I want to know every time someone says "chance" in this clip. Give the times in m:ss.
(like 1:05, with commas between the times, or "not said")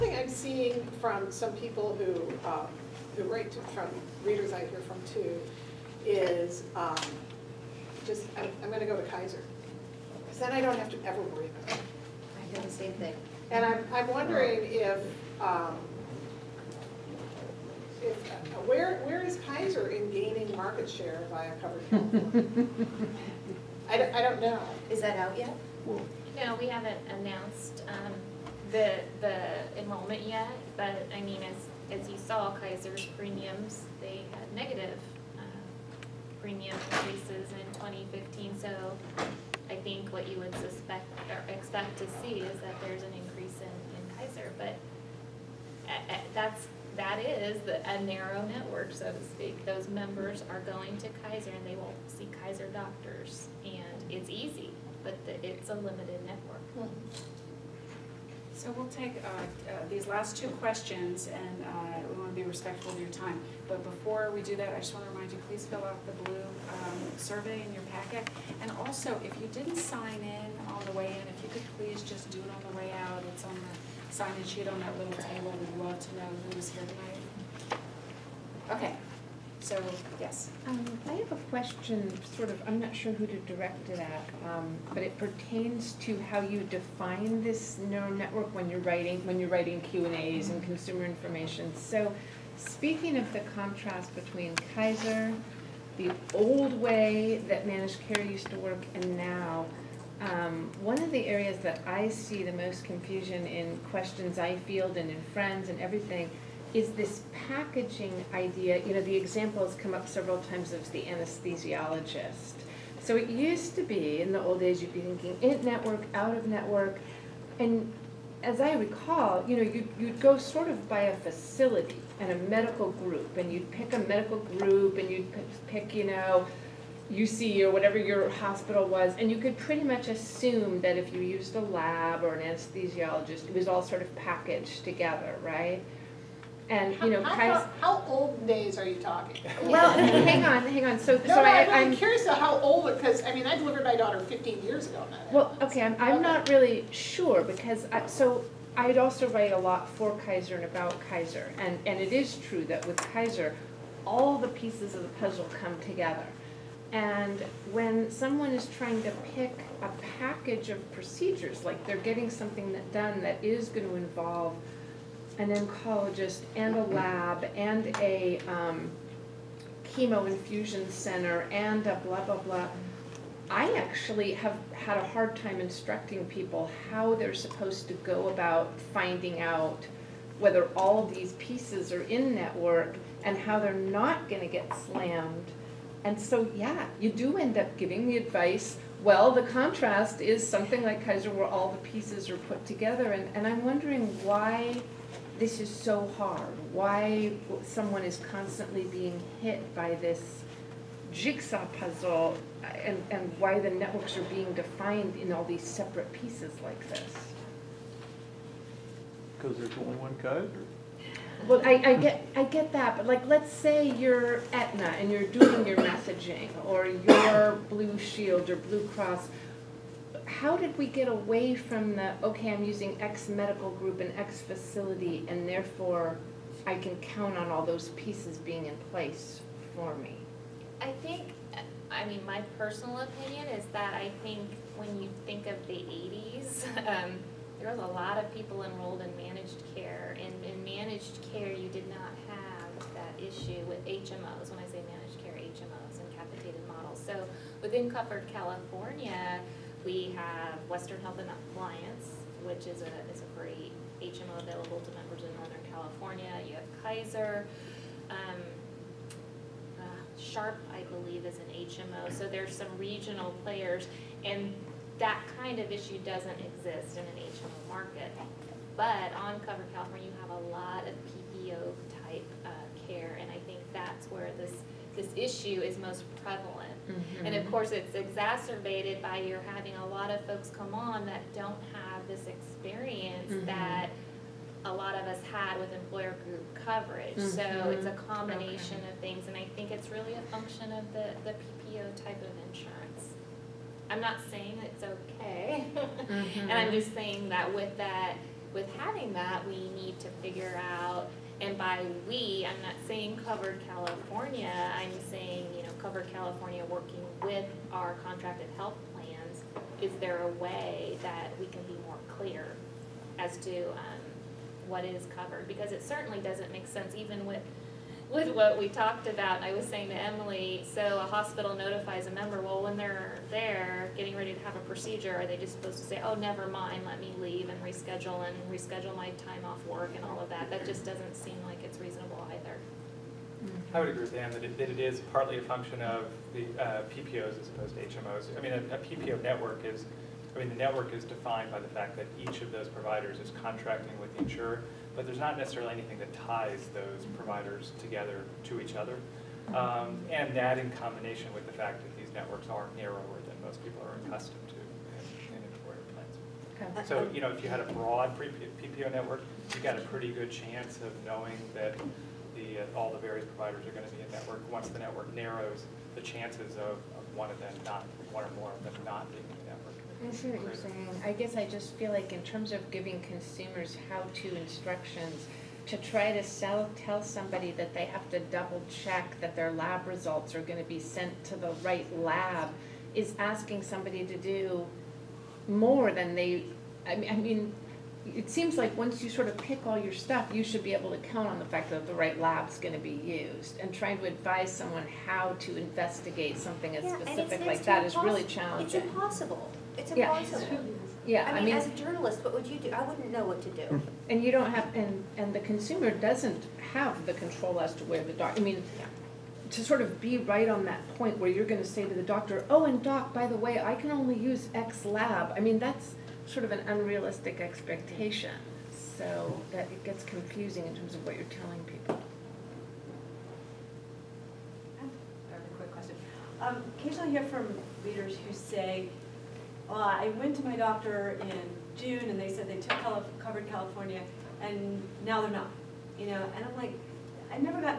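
6:00, 6:06.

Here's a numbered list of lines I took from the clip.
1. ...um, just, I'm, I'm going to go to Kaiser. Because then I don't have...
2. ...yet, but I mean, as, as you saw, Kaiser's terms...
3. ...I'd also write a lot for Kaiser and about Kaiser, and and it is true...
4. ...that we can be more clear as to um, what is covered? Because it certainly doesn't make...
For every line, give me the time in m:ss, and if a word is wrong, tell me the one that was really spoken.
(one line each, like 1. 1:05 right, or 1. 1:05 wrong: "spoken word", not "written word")
1. 0:06 right
2. 0:30 wrong: "premiums", not "terms"
3. 2:28 right
4. 5:11 right.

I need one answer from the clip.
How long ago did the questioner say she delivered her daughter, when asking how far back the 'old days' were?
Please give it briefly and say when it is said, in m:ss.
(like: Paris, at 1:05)
15 years, at 2:24.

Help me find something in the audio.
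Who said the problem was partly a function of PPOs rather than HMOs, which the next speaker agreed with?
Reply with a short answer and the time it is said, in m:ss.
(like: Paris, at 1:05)
Dan, at 5:34.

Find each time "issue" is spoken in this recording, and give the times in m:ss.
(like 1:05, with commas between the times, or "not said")
4:03, 4:25, 4:35.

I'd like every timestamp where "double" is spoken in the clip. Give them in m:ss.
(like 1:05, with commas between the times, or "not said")
6:18.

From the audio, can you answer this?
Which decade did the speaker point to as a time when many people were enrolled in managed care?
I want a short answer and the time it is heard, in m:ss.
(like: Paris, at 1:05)
The 80s, at 3:55.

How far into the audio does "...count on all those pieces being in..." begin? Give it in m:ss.
3:46.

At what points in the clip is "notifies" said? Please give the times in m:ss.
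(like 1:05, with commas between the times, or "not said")
5:21.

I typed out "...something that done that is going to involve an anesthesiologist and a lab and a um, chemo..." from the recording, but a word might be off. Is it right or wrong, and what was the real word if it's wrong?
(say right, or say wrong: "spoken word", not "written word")
wrong: "oncologist", not "anesthesiologist".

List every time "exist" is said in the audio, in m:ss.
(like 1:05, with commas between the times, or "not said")
4:26.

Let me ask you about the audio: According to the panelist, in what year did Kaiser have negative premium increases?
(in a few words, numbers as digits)
2015.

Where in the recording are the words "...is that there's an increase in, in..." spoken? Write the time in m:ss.
0:42.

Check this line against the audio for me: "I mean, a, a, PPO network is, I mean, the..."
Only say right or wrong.
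right.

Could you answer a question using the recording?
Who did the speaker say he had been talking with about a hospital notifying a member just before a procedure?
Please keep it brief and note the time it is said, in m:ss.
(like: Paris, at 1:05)
Emily, at 5:19.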